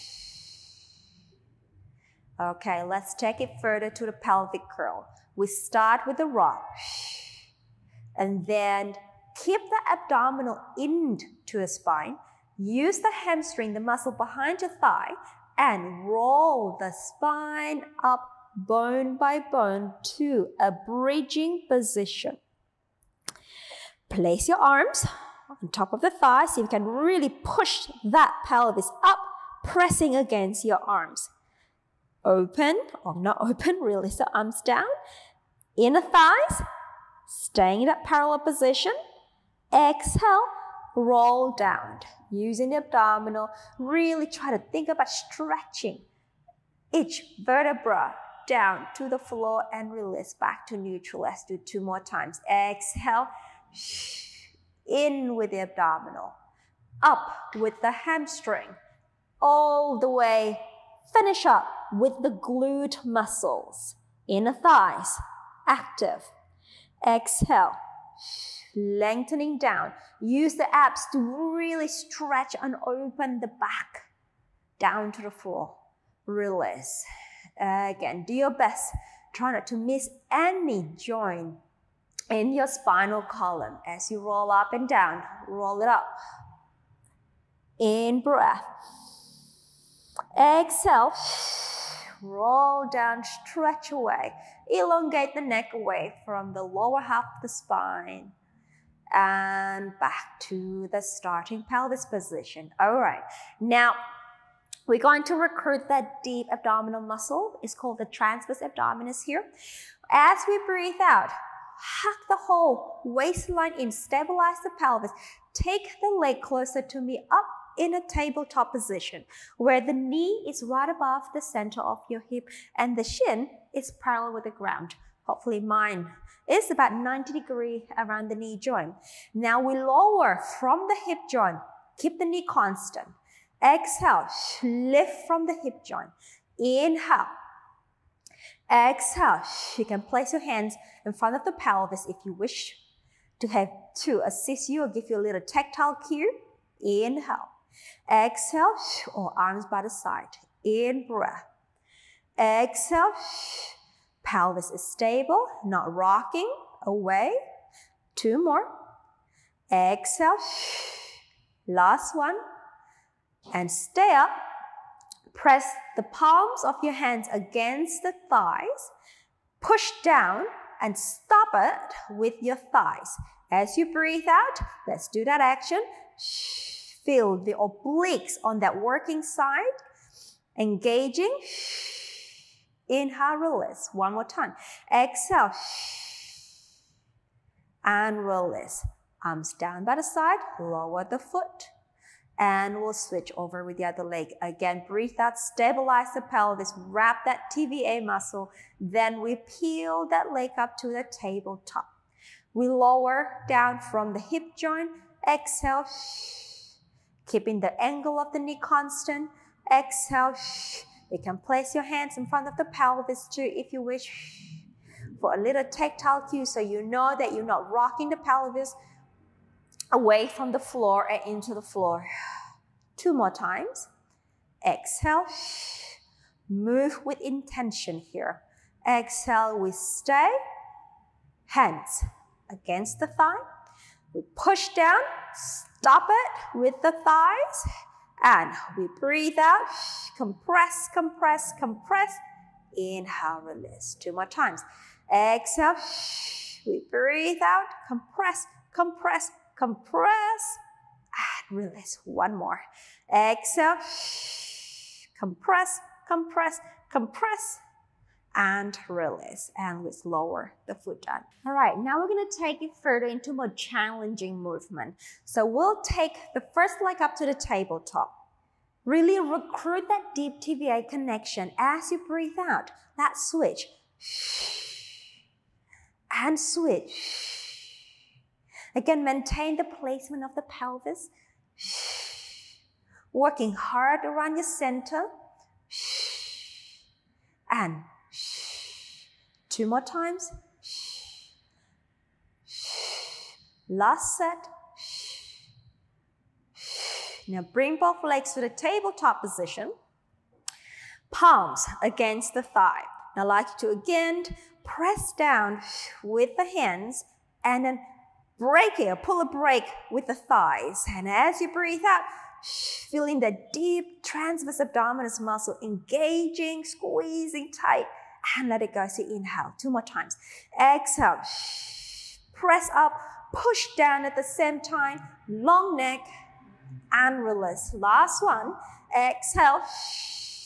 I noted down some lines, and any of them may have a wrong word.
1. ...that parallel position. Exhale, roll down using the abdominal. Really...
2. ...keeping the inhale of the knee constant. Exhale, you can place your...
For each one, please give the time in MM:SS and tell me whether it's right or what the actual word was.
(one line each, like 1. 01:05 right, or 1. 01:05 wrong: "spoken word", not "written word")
1. 00:37 right
2. 03:27 wrong: "angle", not "inhale".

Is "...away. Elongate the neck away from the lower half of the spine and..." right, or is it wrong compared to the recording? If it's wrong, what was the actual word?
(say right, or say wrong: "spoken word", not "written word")
right.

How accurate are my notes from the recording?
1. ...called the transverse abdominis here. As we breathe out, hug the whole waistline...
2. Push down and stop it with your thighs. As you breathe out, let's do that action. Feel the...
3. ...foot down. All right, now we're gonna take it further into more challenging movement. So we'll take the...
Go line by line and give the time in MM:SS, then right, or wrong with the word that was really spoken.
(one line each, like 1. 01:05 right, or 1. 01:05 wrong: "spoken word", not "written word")
1. 01:47 right
2. 02:49 right
3. 04:20 right.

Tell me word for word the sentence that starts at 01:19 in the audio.
Try not to miss any joint in your spinal column as you roll up and down.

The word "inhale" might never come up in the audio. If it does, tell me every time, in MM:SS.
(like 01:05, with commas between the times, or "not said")
02:16, 02:26, 03:03, 04:02, 05:19.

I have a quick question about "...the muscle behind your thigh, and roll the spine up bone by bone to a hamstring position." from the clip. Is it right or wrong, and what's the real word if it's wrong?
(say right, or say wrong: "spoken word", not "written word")
wrong: "bridging", not "hamstring".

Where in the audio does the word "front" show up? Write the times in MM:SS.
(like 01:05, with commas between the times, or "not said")
02:21, 03:32.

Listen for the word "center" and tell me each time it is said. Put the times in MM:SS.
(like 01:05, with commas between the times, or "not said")
02:01, 04:44.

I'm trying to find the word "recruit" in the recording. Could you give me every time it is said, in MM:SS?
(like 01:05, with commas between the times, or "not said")
01:45, 04:29.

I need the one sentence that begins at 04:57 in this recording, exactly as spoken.
Now bring both legs to the tabletop position.